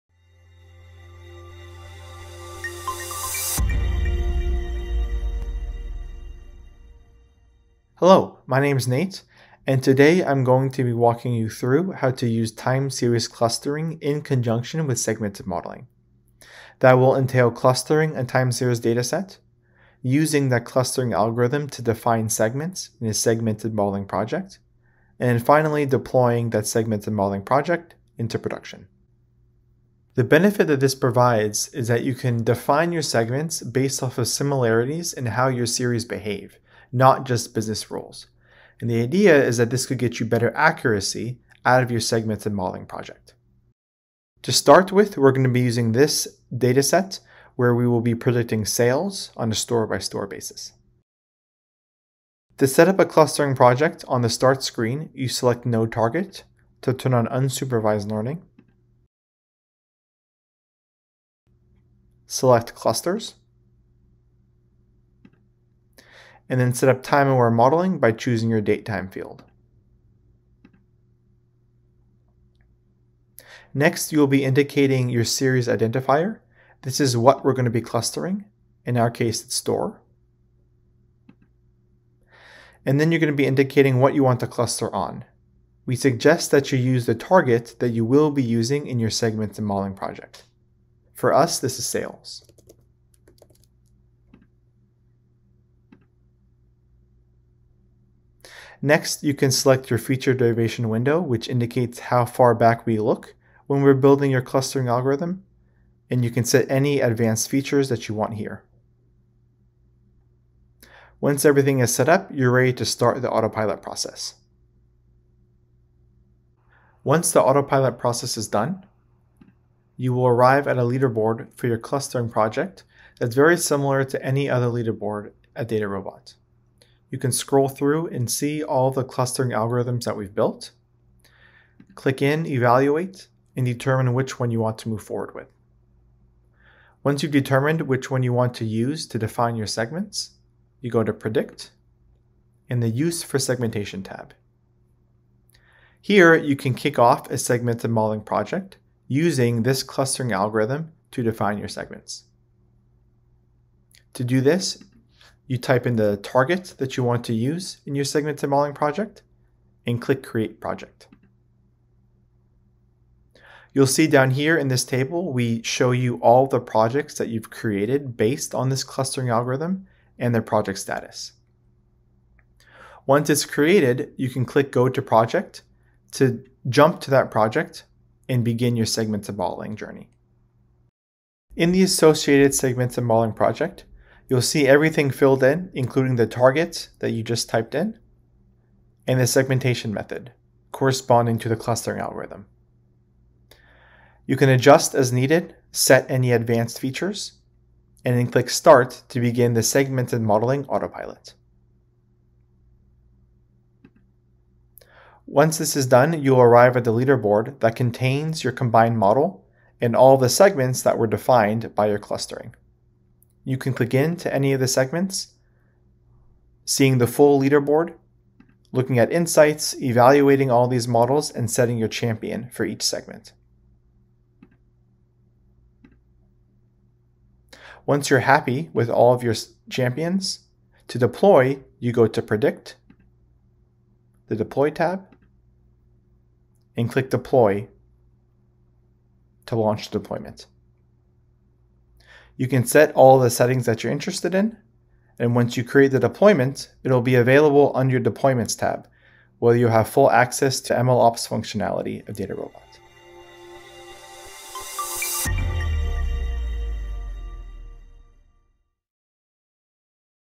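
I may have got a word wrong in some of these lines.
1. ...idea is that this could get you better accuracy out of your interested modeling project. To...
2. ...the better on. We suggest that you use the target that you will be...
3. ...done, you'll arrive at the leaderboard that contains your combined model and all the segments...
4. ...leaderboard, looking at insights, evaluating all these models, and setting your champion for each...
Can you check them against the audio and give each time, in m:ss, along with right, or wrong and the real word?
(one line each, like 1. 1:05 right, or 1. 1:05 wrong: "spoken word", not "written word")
1. 0:39 wrong: "segmented", not "interested"
2. 1:24 wrong: "cluster", not "better"
3. 3:25 right
4. 3:37 right.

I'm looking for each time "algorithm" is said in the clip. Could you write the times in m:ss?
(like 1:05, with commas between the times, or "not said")
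0:21, 1:44, 2:09, 2:30, 2:49, 3:11.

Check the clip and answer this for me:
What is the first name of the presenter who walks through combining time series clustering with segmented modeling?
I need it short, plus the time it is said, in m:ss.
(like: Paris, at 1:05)
Nate, at 0:08.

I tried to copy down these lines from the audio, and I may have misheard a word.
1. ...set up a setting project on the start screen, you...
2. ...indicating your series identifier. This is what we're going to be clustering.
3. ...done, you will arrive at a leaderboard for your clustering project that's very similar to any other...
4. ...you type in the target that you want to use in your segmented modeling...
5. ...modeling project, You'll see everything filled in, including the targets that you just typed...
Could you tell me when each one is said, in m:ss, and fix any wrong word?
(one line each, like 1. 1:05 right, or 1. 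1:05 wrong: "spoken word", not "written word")
1. 0:52 wrong: "clustering", not "setting"
2. 1:14 right
3. 1:58 right
4. 2:35 right
5. 3:03 right.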